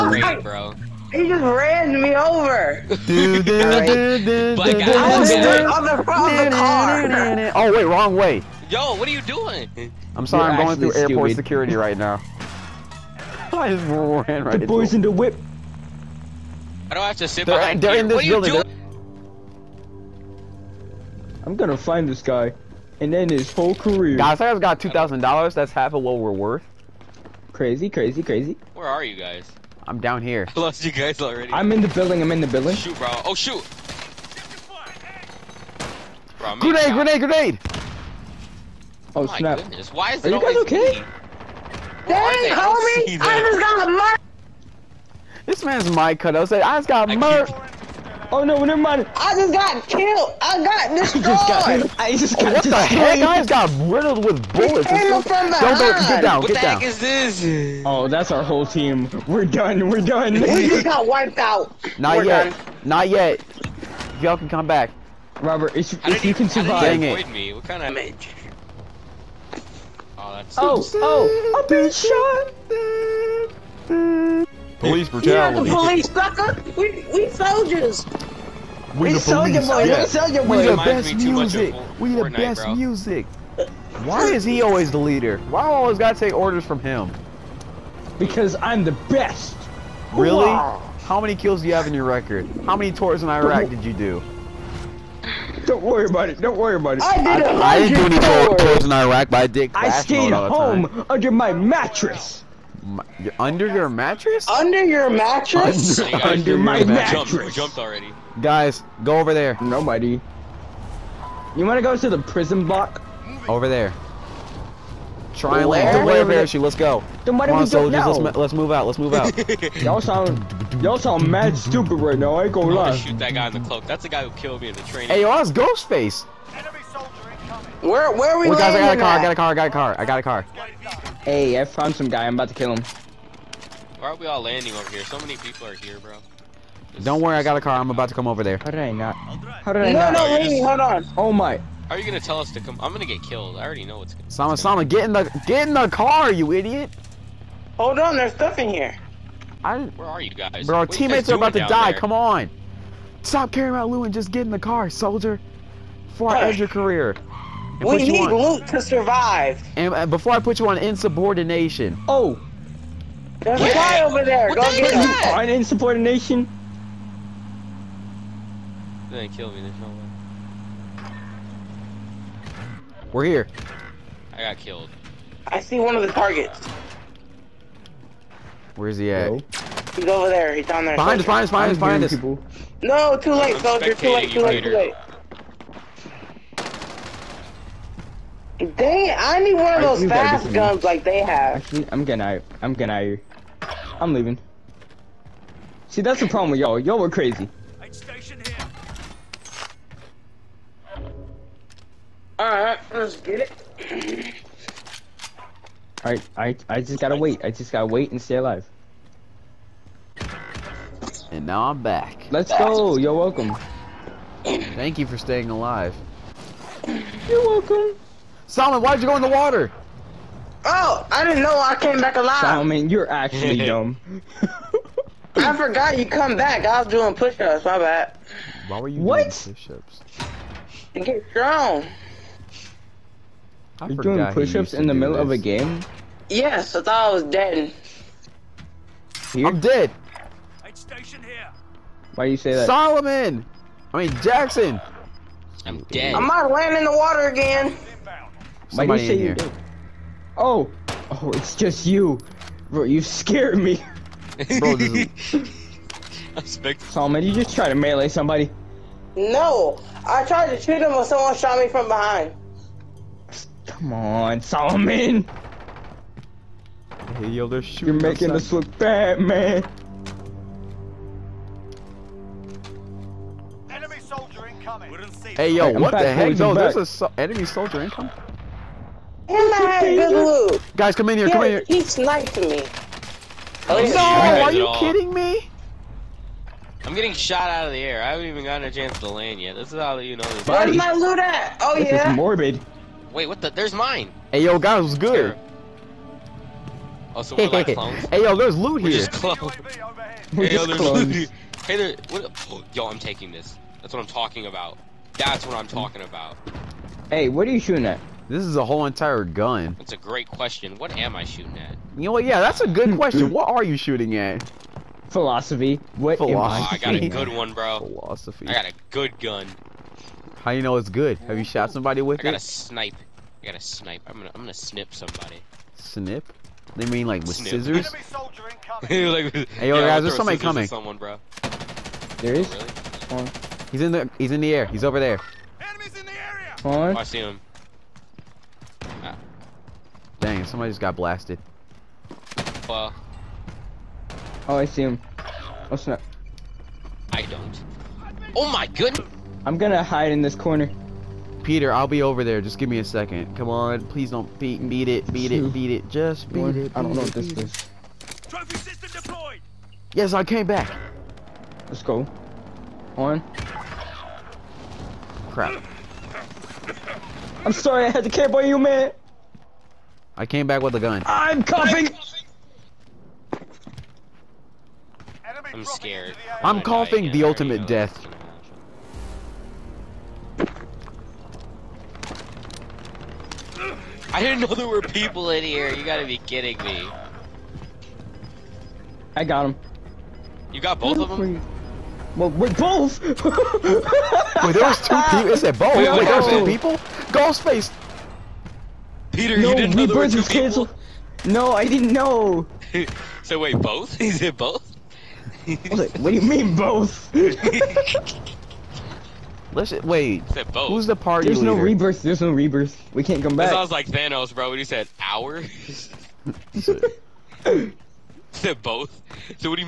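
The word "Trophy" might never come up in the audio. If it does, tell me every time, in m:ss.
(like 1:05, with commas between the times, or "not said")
5:58.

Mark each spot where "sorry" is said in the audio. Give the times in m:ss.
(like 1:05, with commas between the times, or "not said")
0:10, 6:07.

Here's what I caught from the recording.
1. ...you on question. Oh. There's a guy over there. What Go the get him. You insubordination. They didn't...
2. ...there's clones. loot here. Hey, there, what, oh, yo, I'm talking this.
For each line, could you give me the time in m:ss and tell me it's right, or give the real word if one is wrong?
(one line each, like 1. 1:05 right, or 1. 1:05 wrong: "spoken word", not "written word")
1. 2:40 wrong: "insubordination", not "question"
2. 5:00 wrong: "taking", not "talking".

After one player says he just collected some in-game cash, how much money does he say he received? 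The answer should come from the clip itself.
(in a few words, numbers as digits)
2000 dollars.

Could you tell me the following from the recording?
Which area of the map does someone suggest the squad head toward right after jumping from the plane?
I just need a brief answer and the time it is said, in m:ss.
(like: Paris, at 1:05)
the prison block, at 1:52.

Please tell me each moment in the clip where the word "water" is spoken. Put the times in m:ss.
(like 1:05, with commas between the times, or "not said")
3:39, 4:06.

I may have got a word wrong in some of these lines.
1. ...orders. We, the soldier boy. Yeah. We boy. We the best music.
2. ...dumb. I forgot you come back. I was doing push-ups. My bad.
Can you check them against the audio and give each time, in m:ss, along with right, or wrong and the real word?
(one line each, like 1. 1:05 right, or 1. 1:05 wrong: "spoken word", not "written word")
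1. 1:17 wrong: "soldiers", not "orders"
2. 3:43 right.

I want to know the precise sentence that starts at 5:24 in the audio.
I'm gonna, I'm gonna snip somebody.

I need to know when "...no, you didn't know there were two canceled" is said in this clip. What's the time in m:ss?
6:39.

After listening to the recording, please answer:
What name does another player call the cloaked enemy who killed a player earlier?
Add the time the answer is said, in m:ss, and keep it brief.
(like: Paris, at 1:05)
Ghostface, at 2:05.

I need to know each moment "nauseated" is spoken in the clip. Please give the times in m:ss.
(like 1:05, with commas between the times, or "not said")
not said.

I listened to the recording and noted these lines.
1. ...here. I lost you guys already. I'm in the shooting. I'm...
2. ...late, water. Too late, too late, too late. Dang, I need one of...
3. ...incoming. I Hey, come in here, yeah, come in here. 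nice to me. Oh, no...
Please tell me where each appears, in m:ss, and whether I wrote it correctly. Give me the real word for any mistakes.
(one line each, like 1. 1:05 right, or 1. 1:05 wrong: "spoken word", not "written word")
1. 0:30 wrong: "building", not "shooting"
2. 3:03 wrong: "soldier", not "water"
3. 4:37 wrong: "Guys", not "Hey".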